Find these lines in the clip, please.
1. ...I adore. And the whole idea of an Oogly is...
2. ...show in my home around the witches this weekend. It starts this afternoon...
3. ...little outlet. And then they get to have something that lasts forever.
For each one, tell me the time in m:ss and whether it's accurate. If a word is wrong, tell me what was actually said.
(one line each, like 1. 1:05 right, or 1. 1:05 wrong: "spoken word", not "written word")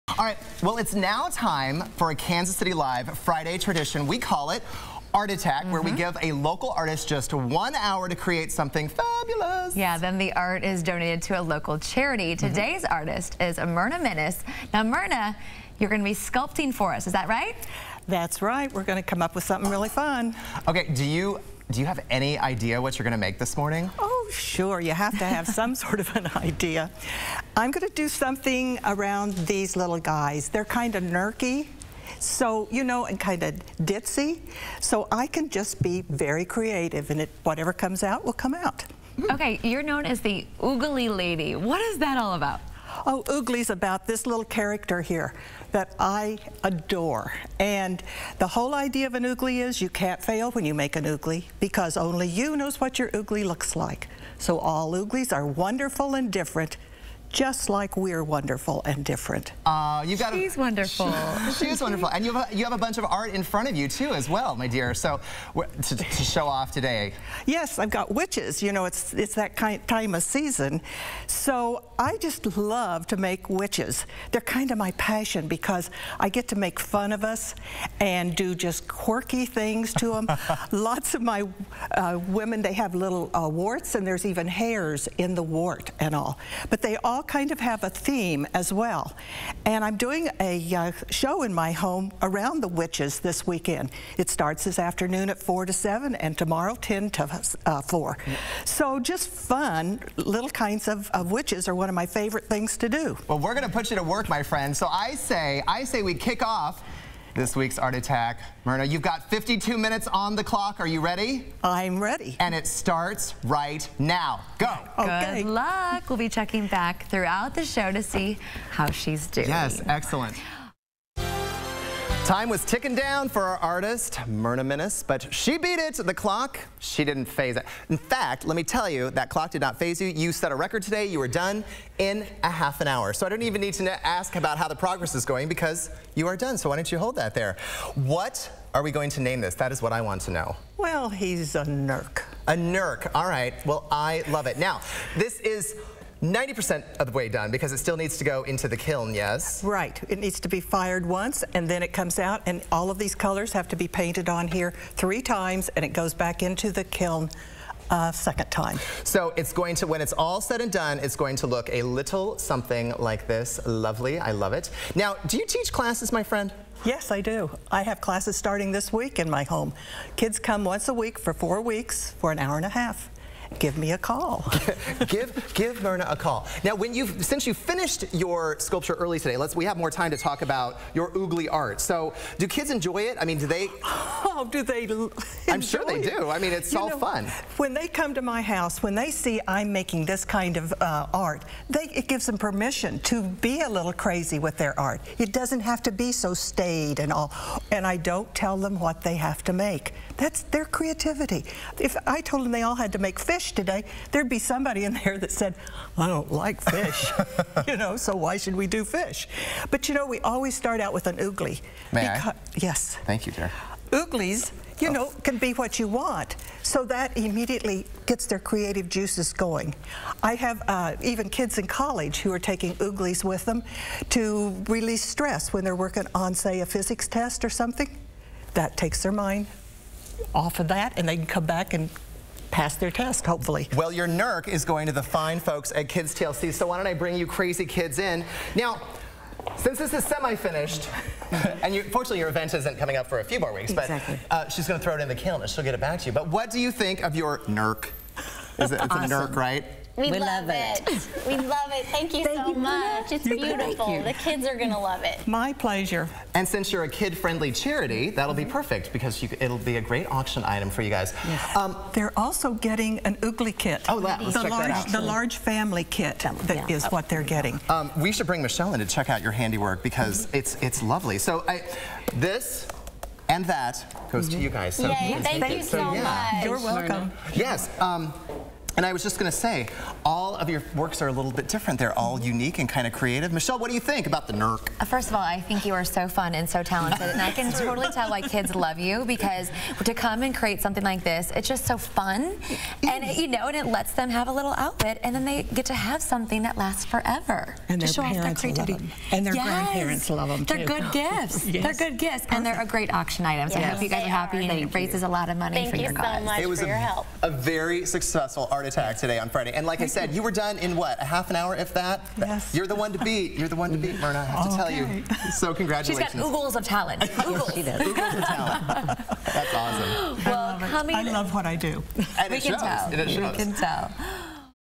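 1. 0:45 right
2. 1:31 right
3. 4:54 right.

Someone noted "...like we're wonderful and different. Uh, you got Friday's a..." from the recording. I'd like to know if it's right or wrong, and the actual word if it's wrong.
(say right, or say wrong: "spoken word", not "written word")
wrong: "She", not "Friday".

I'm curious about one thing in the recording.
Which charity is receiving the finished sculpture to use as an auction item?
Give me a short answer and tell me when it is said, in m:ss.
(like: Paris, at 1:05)
Kids TLC, at 3:55.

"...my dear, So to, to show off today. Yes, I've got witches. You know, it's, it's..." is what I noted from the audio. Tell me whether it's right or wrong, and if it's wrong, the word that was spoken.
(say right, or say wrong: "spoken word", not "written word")
right.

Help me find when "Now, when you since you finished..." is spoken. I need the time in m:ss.
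2:56.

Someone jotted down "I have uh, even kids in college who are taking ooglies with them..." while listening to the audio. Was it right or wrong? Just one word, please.
right.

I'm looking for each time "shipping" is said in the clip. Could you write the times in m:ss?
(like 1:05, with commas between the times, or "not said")
not said.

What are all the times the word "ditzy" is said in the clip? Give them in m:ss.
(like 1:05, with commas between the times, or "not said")
0:33.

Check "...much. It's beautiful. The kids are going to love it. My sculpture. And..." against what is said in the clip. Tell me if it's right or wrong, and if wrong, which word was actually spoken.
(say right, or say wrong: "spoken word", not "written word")
wrong: "pleasure", not "sculpture".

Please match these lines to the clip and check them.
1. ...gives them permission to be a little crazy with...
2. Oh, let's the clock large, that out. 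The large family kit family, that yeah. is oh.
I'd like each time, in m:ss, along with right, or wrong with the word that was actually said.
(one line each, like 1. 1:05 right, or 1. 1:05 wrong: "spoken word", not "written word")
1. 3:12 right
2. 4:23 wrong: "check", not "clock".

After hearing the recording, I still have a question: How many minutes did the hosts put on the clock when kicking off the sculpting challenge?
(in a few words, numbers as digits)
52.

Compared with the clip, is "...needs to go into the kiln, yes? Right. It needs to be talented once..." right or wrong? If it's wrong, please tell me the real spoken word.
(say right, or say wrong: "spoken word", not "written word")
wrong: "fired", not "talented".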